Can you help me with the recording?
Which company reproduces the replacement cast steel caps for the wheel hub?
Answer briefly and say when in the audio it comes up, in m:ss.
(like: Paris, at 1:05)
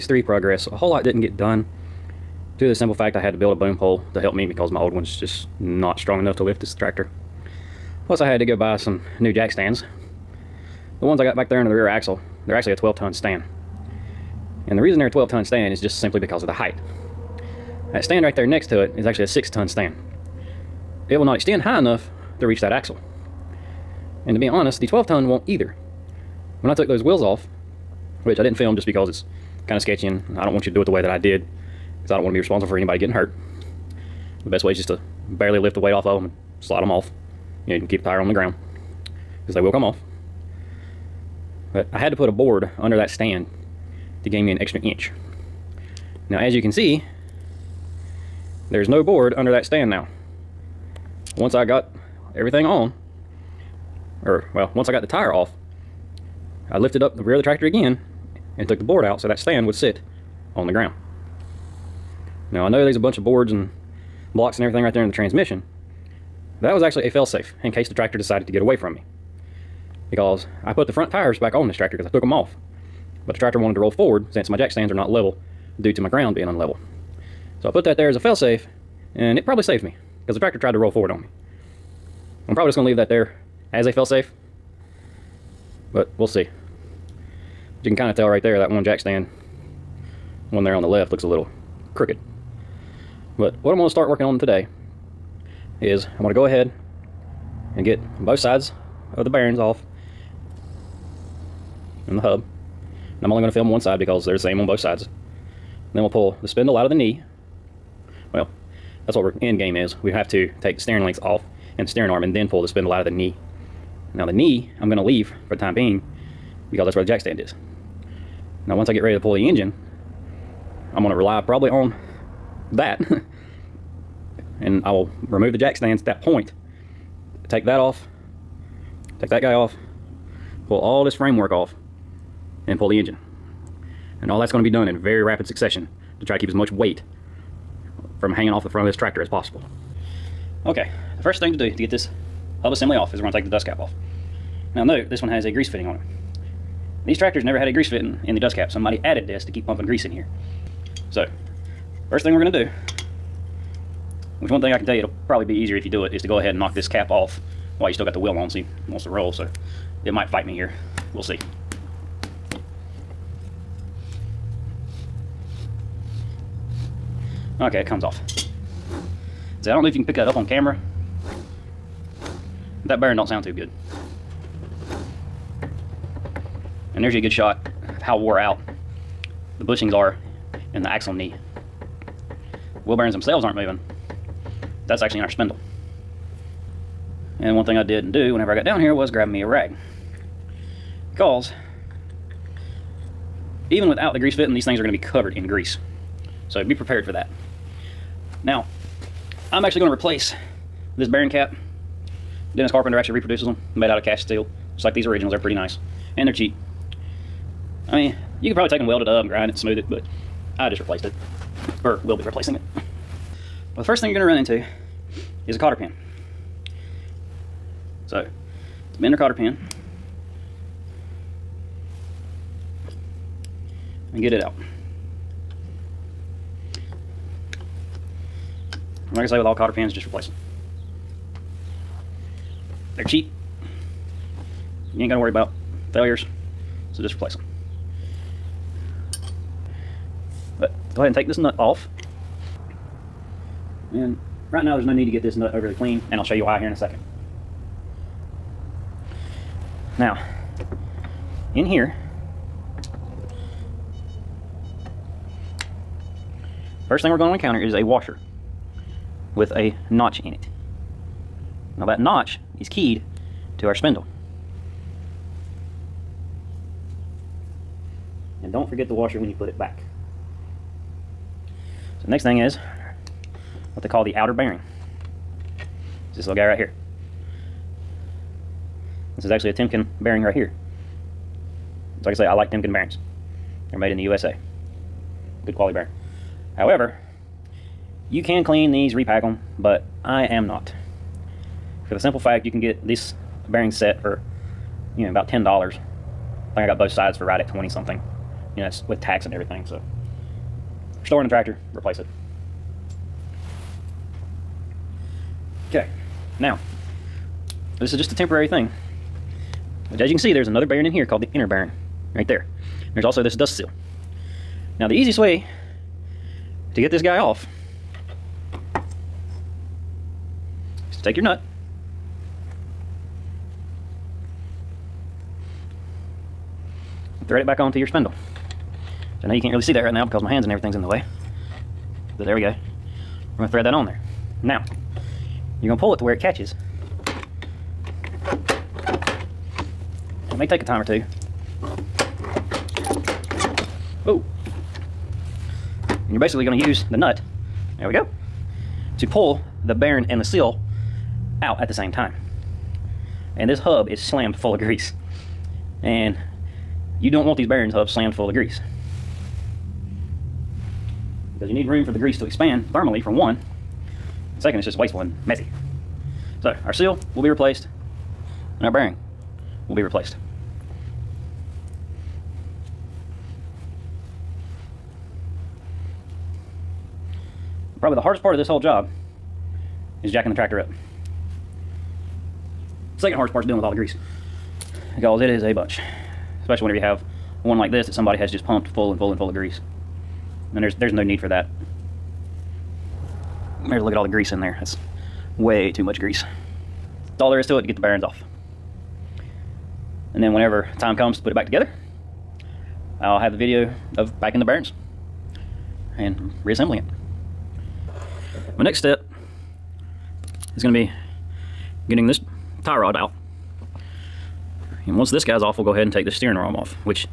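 Dennis Carpenter, at 3:22.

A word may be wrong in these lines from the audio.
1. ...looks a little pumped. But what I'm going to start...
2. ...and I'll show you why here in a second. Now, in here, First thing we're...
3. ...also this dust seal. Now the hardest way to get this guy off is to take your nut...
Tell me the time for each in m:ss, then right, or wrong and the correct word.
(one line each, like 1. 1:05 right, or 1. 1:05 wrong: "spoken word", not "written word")
1. 1:31 wrong: "crooked", not "pumped"
2. 4:06 right
3. 5:13 wrong: "easiest", not "hardest".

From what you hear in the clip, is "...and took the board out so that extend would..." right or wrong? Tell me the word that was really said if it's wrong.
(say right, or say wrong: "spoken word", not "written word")
wrong: "stand", not "extend".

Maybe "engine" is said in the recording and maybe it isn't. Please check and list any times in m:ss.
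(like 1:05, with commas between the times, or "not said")
1:59, 2:12.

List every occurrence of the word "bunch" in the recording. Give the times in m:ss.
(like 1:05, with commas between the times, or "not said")
1:02, 6:25.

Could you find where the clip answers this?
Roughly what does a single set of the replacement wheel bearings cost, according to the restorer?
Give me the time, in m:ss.
4:55.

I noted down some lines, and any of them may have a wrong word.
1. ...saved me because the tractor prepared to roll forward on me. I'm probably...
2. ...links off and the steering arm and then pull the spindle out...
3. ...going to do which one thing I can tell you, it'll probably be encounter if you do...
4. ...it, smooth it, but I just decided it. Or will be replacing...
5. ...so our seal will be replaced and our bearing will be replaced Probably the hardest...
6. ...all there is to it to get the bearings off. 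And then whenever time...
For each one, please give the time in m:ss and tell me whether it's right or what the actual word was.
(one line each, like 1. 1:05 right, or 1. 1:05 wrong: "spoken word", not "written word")
1. 1:19 wrong: "tried", not "prepared"
2. 1:51 right
3. 2:32 wrong: "easier", not "encounter"
4. 3:29 wrong: "replaced", not "decided"
5. 6:06 right
6. 6:37 right.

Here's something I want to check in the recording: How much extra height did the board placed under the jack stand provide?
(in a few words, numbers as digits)
an extra inch.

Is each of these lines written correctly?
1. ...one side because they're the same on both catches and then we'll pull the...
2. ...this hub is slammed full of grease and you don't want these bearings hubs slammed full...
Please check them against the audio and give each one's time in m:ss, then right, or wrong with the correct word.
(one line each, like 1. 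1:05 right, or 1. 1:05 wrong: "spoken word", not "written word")
1. 1:43 wrong: "sides", not "catches"
2. 5:53 right.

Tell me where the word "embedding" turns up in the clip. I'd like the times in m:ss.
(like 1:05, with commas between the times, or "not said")
not said.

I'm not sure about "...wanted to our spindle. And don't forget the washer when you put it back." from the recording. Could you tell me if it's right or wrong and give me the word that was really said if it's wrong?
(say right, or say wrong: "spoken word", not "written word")
wrong: "keyed", not "wanted".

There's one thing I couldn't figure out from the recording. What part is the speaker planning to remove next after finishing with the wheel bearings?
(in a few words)
tie rod.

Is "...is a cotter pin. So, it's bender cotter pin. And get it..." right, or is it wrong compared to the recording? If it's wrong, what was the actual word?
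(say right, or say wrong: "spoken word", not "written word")
right.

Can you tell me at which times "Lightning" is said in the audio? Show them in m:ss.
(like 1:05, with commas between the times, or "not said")
not said.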